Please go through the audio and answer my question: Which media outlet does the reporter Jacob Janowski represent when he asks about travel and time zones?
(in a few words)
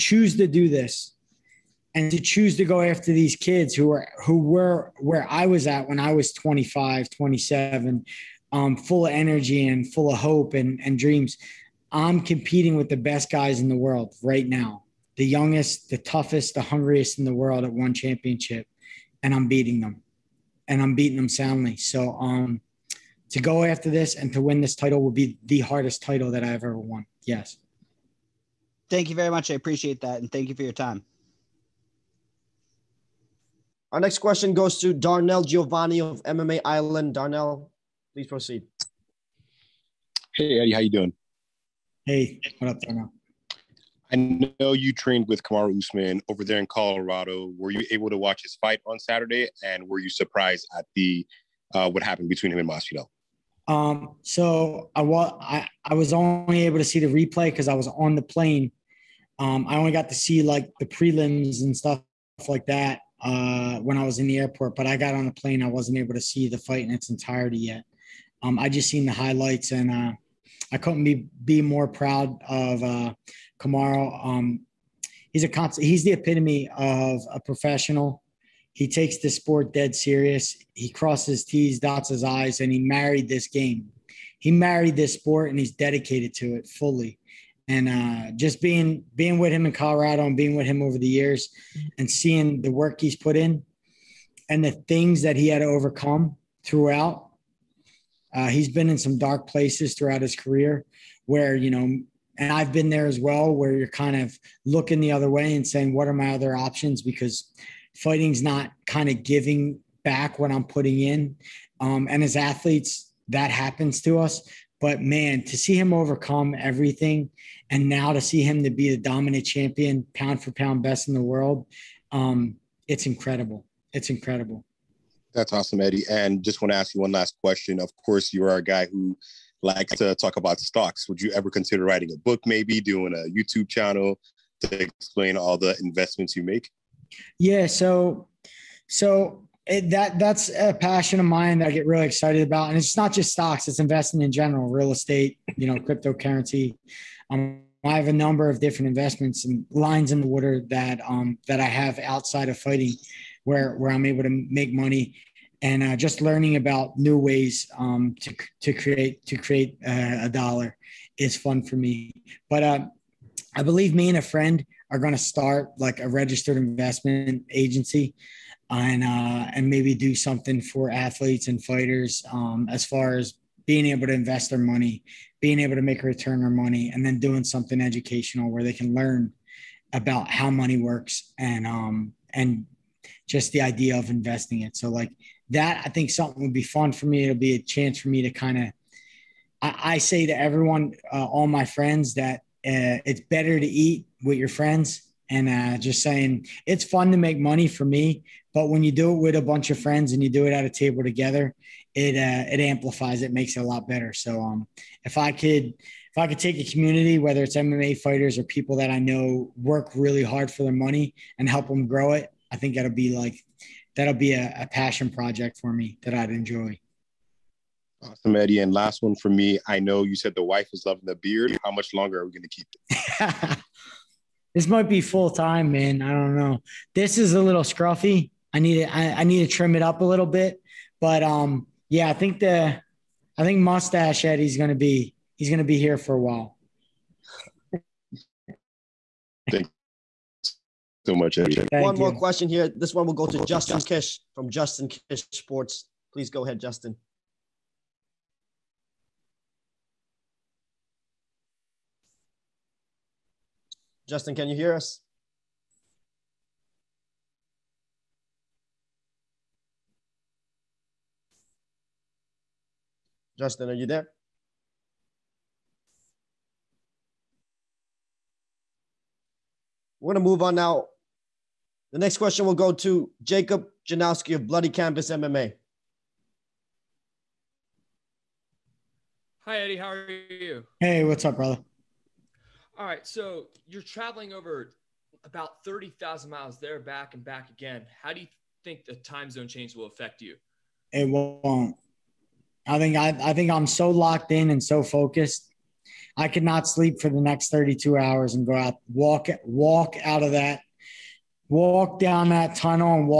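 Bloody Canvas MMA.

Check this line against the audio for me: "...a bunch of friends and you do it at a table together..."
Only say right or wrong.
right.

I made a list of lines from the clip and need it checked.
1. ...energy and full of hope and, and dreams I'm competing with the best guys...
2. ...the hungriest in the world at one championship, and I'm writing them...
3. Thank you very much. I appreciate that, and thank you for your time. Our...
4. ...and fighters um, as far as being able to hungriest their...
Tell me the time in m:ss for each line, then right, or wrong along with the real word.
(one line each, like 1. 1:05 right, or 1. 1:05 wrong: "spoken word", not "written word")
1. 0:09 right
2. 0:16 wrong: "beating", not "writing"
3. 0:28 right
4. 2:51 wrong: "invest", not "hungriest".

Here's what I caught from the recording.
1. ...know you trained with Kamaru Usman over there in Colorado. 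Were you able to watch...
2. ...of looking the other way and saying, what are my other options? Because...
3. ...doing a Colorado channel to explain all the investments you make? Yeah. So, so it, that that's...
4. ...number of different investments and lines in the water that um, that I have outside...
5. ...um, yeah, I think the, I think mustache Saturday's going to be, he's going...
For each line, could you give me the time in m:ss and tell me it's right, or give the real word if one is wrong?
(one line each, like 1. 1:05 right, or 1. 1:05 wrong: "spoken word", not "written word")
1. 0:44 right
2. 1:44 right
3. 2:12 wrong: "YouTube", not "Colorado"
4. 2:28 right
5. 3:51 wrong: "Eddie", not "Saturday".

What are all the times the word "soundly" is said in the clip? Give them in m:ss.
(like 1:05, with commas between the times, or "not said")
0:21.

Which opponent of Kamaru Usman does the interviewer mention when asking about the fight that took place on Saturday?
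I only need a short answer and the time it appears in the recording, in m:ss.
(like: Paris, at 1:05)
Masvidal, at 0:52.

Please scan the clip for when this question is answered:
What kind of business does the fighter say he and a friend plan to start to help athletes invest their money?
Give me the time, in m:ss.
2:46.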